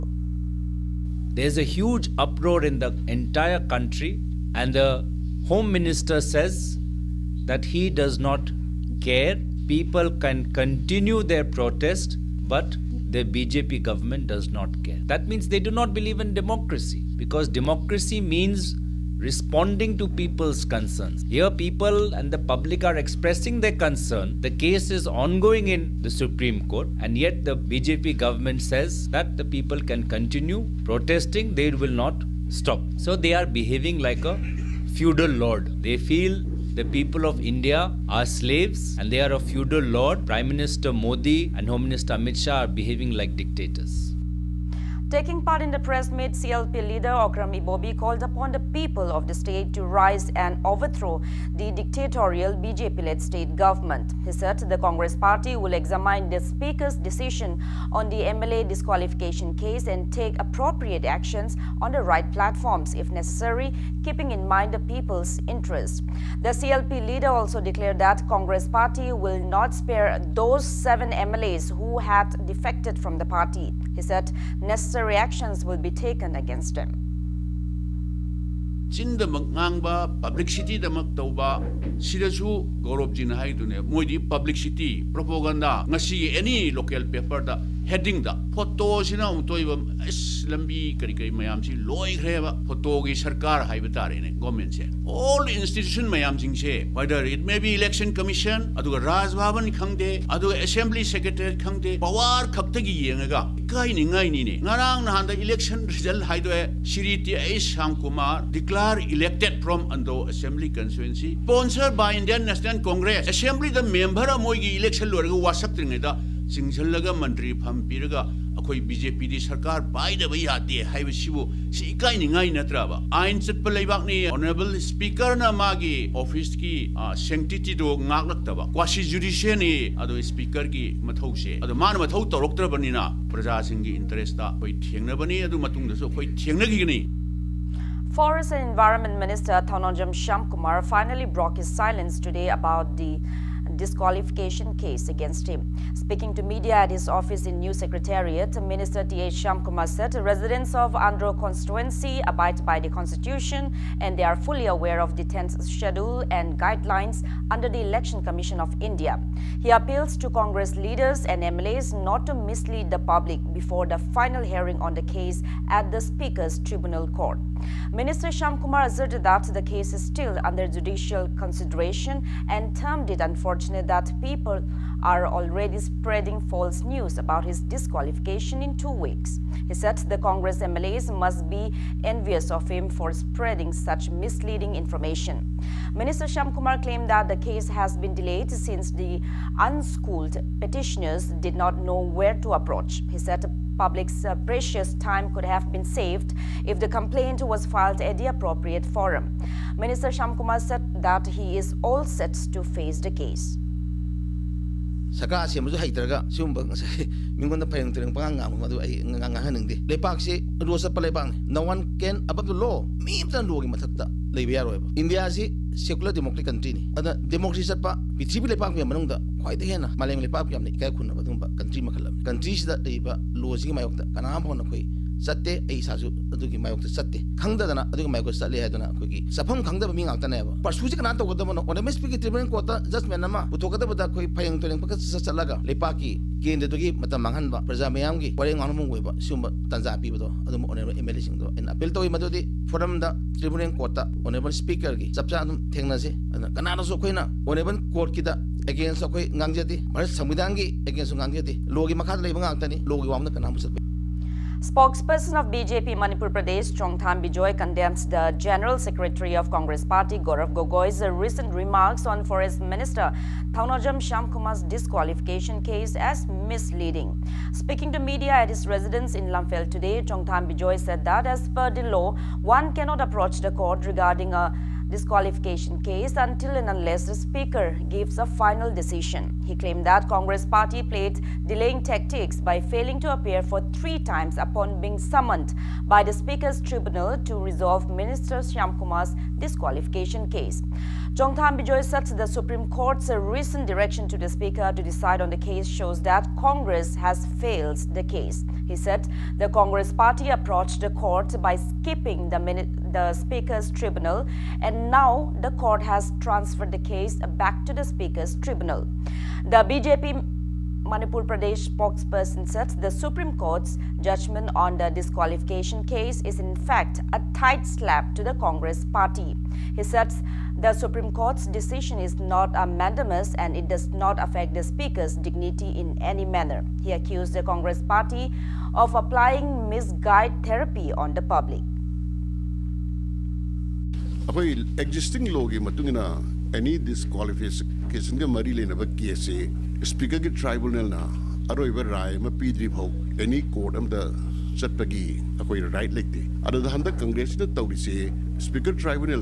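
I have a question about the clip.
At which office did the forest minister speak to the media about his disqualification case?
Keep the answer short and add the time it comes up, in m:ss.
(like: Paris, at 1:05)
New Secretariat, at 2:27.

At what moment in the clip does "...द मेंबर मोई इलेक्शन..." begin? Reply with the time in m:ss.
1:53.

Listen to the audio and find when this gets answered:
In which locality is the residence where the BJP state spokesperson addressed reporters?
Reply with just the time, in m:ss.
4:29.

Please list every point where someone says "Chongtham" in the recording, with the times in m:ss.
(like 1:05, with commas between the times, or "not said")
4:16, 4:30, 4:51.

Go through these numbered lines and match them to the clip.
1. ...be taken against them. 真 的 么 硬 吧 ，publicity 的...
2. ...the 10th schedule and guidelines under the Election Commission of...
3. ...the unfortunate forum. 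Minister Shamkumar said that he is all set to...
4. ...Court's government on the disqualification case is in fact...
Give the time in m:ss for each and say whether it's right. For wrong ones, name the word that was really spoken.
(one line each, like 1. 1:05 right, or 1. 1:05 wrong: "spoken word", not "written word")
1. 1:15 right
2. 2:35 right
3. 3:18 wrong: "appropriate", not "unfortunate"
4. 5:13 wrong: "judgment", not "government".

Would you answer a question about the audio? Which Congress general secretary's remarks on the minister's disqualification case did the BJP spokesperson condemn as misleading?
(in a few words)
Gaurav Gogoi.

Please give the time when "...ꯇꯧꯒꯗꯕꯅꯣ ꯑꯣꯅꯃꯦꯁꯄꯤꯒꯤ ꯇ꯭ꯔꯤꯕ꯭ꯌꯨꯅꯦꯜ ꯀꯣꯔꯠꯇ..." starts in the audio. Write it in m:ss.
3:51.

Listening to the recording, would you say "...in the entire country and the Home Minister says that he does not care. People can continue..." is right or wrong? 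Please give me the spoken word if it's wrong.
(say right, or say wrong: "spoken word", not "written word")
right.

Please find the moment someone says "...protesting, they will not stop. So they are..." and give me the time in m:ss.
0:30.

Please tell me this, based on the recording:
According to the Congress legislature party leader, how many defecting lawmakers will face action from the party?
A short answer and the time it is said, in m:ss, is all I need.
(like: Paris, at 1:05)
7, at 1:10.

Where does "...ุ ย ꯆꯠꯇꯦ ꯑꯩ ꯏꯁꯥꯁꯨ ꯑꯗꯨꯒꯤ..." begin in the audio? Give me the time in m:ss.
3:44.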